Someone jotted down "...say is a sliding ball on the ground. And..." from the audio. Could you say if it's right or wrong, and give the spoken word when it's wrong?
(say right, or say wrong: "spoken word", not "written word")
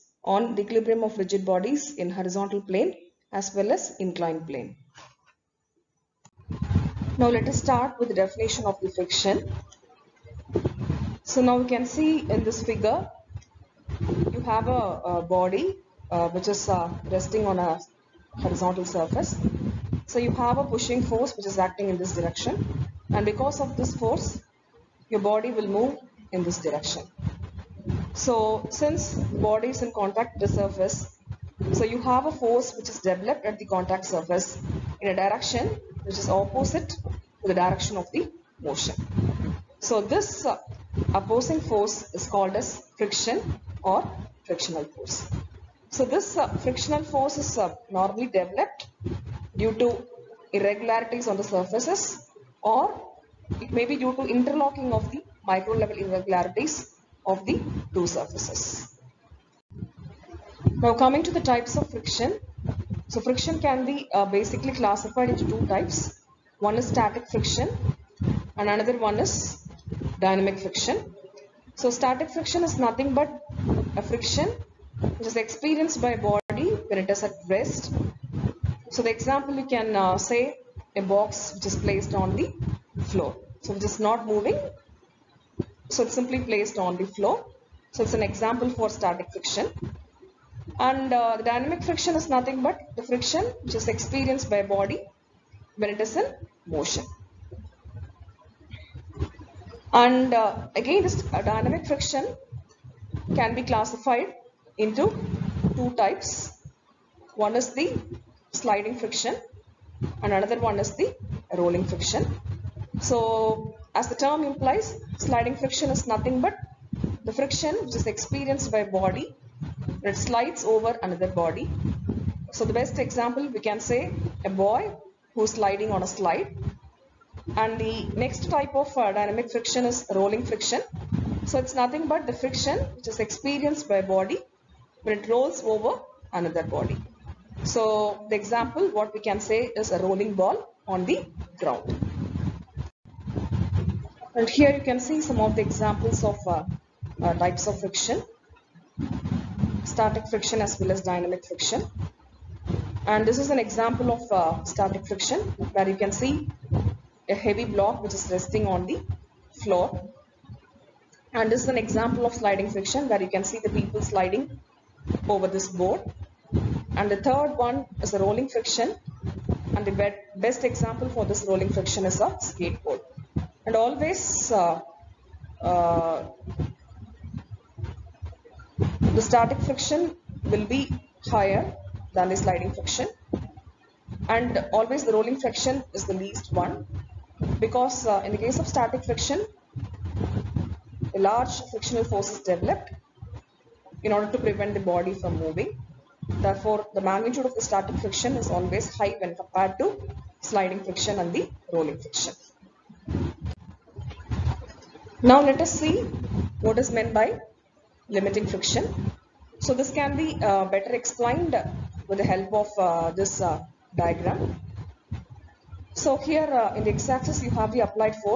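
wrong: "rolling", not "sliding".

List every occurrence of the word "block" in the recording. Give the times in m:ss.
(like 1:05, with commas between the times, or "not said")
2:37.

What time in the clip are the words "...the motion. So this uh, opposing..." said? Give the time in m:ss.
0:38.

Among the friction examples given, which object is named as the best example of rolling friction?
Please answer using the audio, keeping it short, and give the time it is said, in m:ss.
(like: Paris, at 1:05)
Skateboard, at 2:52.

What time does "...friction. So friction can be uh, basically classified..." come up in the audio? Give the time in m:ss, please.
1:01.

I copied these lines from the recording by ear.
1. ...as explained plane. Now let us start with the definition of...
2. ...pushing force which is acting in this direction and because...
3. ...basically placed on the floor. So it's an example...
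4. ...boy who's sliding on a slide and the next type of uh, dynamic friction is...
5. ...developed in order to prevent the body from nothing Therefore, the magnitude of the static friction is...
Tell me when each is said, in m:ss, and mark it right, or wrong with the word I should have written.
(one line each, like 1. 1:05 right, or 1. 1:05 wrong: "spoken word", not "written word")
1. 0:03 wrong: "inclined", not "explained"
2. 0:20 right
3. 1:26 wrong: "simply", not "basically"
4. 2:04 right
5. 3:12 wrong: "moving", not "nothing".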